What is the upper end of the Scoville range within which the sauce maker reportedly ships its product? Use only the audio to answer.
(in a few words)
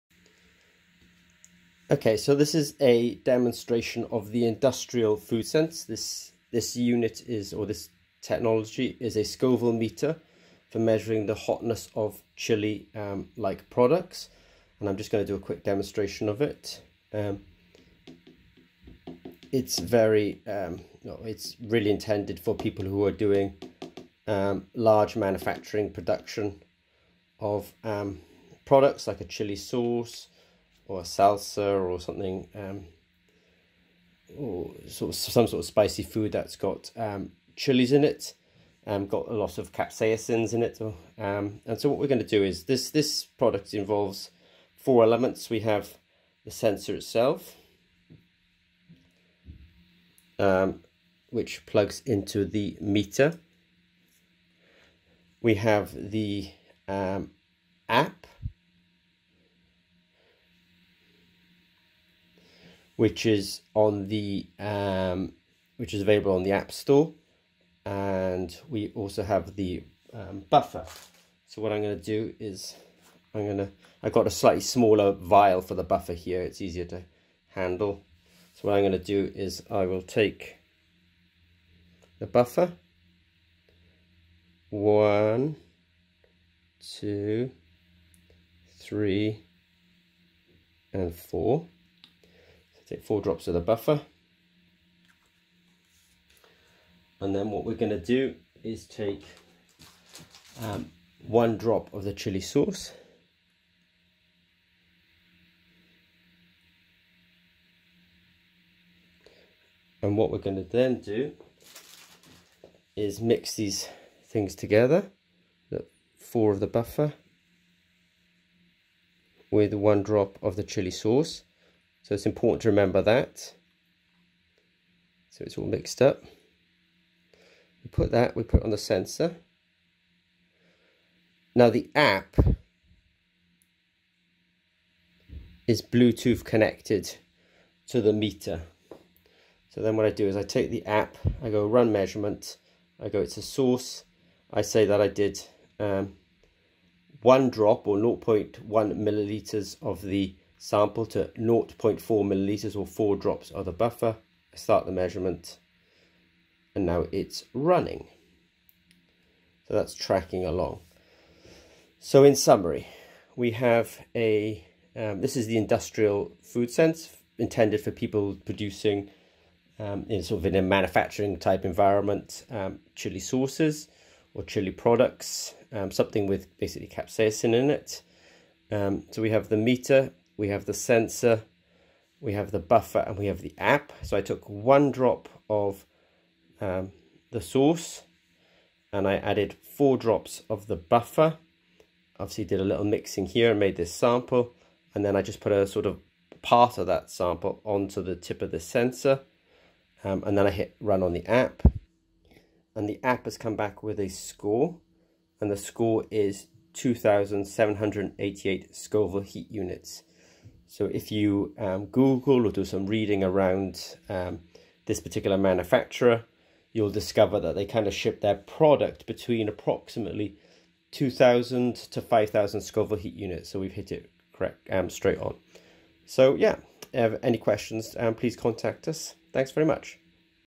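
5,000.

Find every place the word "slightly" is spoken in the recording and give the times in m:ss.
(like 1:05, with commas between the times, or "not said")
1:14.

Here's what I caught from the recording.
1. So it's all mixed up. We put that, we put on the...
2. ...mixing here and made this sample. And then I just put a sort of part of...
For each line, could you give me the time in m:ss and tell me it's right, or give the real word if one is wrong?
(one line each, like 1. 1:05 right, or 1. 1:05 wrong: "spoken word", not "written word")
1. 2:05 right
2. 3:12 right.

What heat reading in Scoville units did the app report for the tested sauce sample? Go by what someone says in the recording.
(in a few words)
2,788.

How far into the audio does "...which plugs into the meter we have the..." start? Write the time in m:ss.
0:51.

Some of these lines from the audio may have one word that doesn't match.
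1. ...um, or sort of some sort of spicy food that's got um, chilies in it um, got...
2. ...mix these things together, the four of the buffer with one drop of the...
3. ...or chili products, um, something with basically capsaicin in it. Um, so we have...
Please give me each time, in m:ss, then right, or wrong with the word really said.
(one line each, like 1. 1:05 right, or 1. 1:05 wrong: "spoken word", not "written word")
1. 0:32 right
2. 1:53 right
3. 2:54 right.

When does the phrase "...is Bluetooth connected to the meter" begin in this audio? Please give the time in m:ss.
2:15.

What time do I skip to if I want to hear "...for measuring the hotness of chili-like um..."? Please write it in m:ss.
0:10.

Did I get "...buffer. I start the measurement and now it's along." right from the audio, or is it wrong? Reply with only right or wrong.
wrong.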